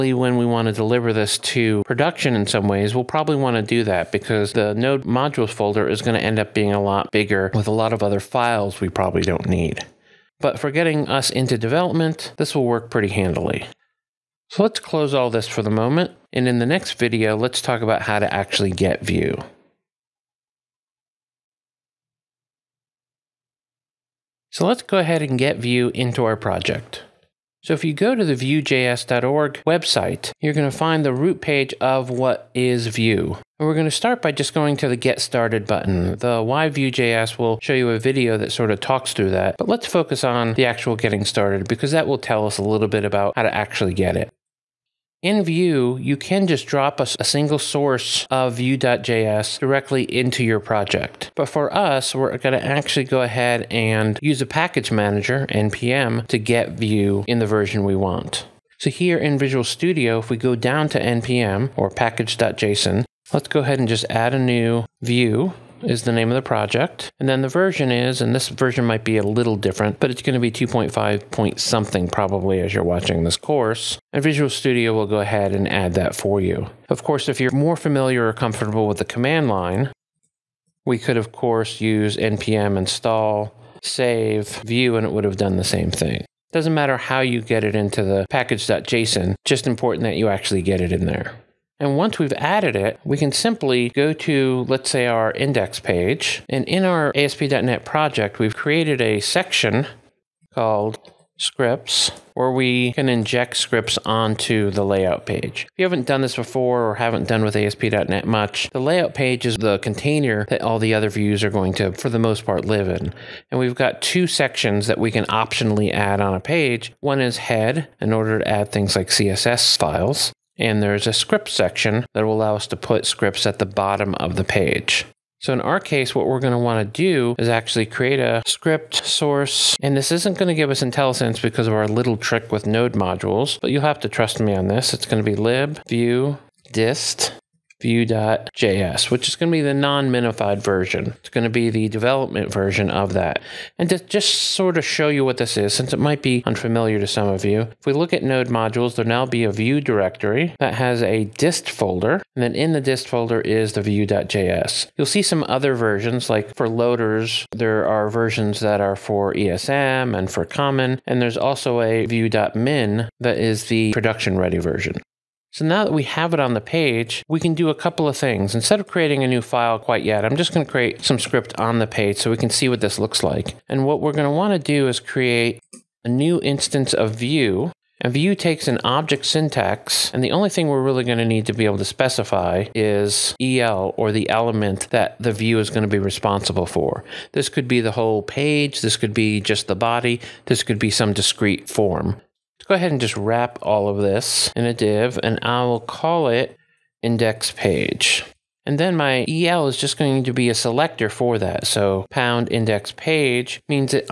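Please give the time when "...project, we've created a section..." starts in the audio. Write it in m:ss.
1:37.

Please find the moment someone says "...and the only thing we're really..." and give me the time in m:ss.
3:00.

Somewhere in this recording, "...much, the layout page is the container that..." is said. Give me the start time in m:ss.
1:48.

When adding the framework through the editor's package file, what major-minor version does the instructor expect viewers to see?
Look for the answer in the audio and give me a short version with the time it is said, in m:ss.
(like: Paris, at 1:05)
2.5, at 1:10.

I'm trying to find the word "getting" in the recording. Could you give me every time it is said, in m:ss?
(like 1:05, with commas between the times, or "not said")
0:10, 0:40.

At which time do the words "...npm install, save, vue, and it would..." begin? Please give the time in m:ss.
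1:22.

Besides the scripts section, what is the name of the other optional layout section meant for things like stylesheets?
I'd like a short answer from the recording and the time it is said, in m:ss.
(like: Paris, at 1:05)
head, at 1:57.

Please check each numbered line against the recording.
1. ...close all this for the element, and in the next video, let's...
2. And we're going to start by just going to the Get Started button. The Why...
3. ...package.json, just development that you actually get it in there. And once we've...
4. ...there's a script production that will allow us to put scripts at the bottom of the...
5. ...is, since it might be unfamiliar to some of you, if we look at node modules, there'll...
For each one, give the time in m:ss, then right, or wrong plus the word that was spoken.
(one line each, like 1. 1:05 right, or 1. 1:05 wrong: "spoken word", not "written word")
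1. 0:14 wrong: "moment", not "element"
2. 0:33 right
3. 1:28 wrong: "important", not "development"
4. 2:00 wrong: "section", not "production"
5. 2:25 right.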